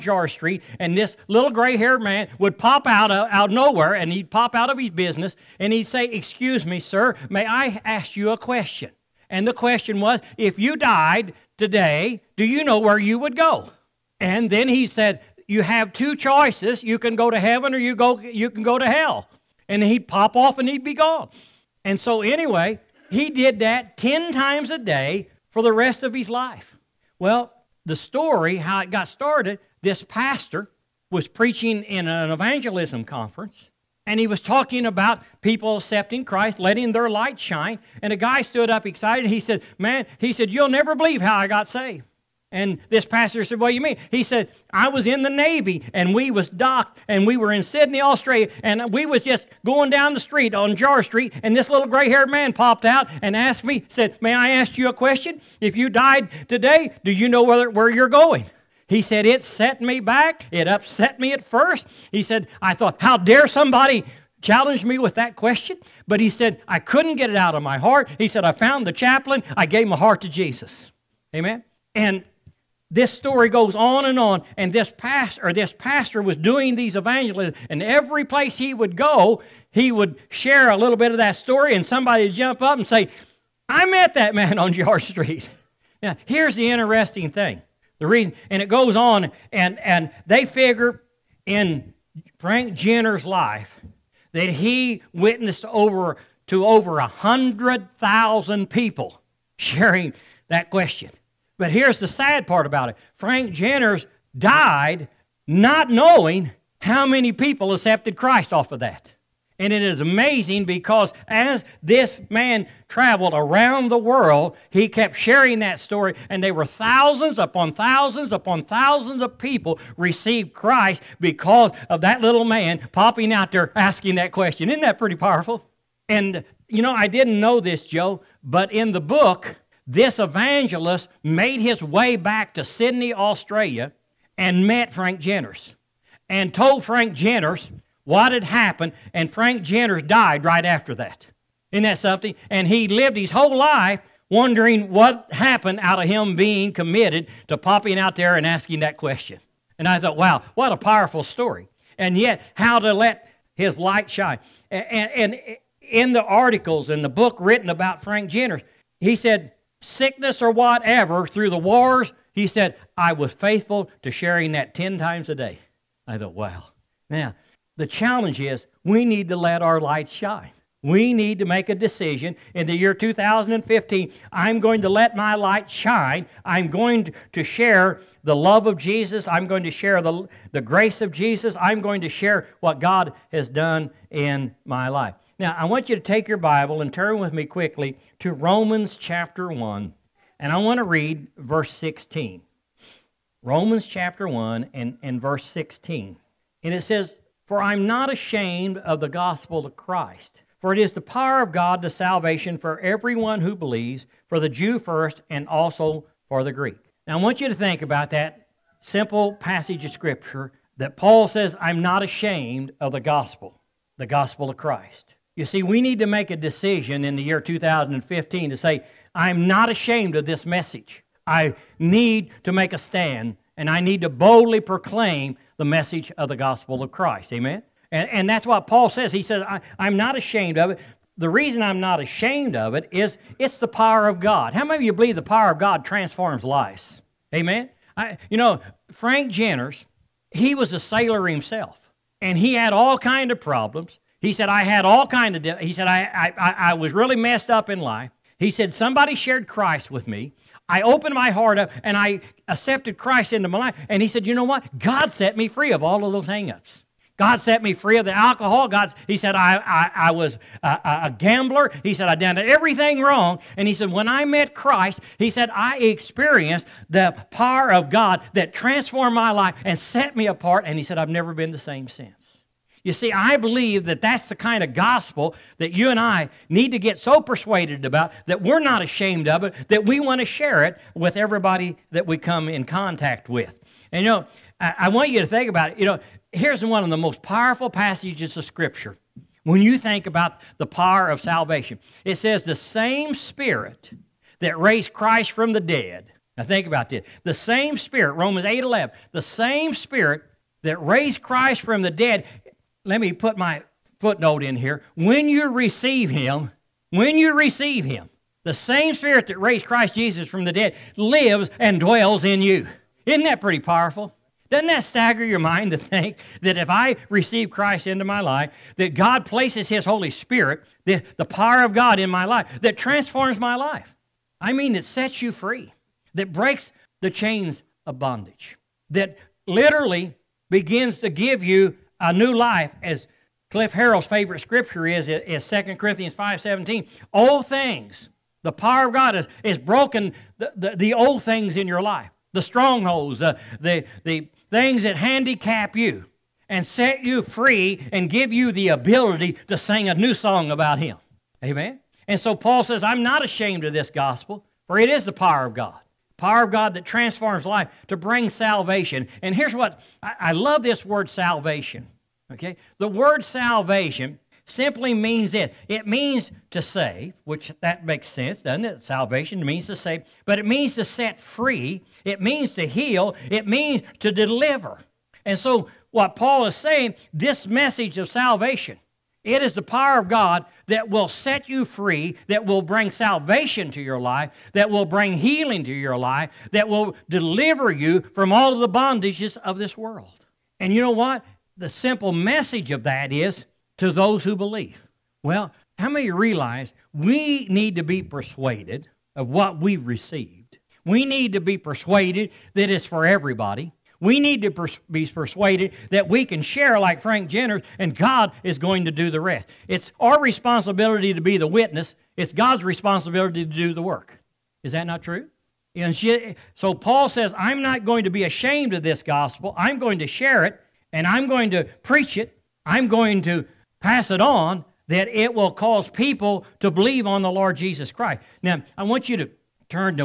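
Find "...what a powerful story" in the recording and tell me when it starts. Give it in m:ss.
2:30.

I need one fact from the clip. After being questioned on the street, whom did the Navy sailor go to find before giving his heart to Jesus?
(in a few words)
The chaplain.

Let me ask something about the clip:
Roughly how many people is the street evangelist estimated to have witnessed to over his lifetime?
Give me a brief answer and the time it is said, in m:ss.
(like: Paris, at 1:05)
Over 100,000, at 1:36.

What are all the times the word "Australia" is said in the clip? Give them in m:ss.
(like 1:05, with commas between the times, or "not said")
0:47, 2:13.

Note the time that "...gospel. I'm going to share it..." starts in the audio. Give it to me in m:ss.
6:59.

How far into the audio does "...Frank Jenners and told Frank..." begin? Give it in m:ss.
2:14.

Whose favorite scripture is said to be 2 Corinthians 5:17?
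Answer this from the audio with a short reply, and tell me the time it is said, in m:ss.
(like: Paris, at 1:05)
Cliff Harrell, at 5:33.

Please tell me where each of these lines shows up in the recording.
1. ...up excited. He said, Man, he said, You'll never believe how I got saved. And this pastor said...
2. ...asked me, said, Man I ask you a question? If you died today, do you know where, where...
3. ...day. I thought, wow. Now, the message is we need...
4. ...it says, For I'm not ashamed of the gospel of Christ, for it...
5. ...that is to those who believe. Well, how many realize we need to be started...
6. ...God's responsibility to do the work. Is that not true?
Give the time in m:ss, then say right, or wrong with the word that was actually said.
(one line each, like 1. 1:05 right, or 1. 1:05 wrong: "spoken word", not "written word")
1. 0:38 right
2. 0:53 wrong: "May", not "Man"
3. 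2:45 wrong: "challenge", not "message"
4. 3:16 right
5. 6:32 wrong: "persuaded", not "started"
6. 6:52 right.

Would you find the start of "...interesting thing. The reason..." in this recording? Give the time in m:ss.
1:26.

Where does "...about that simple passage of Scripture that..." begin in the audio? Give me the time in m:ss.
3:27.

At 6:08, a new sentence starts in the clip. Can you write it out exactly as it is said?
Salvation means to save, but it means to set free, it means to heal, it means to deliver.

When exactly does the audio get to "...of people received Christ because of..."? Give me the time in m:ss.
1:59.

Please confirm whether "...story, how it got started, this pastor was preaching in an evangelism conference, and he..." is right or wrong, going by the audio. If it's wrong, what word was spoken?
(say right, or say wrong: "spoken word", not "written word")
right.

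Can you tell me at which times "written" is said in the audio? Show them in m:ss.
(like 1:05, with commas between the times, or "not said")
2:37.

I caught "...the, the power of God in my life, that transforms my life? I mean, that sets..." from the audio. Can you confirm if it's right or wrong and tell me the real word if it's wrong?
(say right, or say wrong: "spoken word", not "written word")
right.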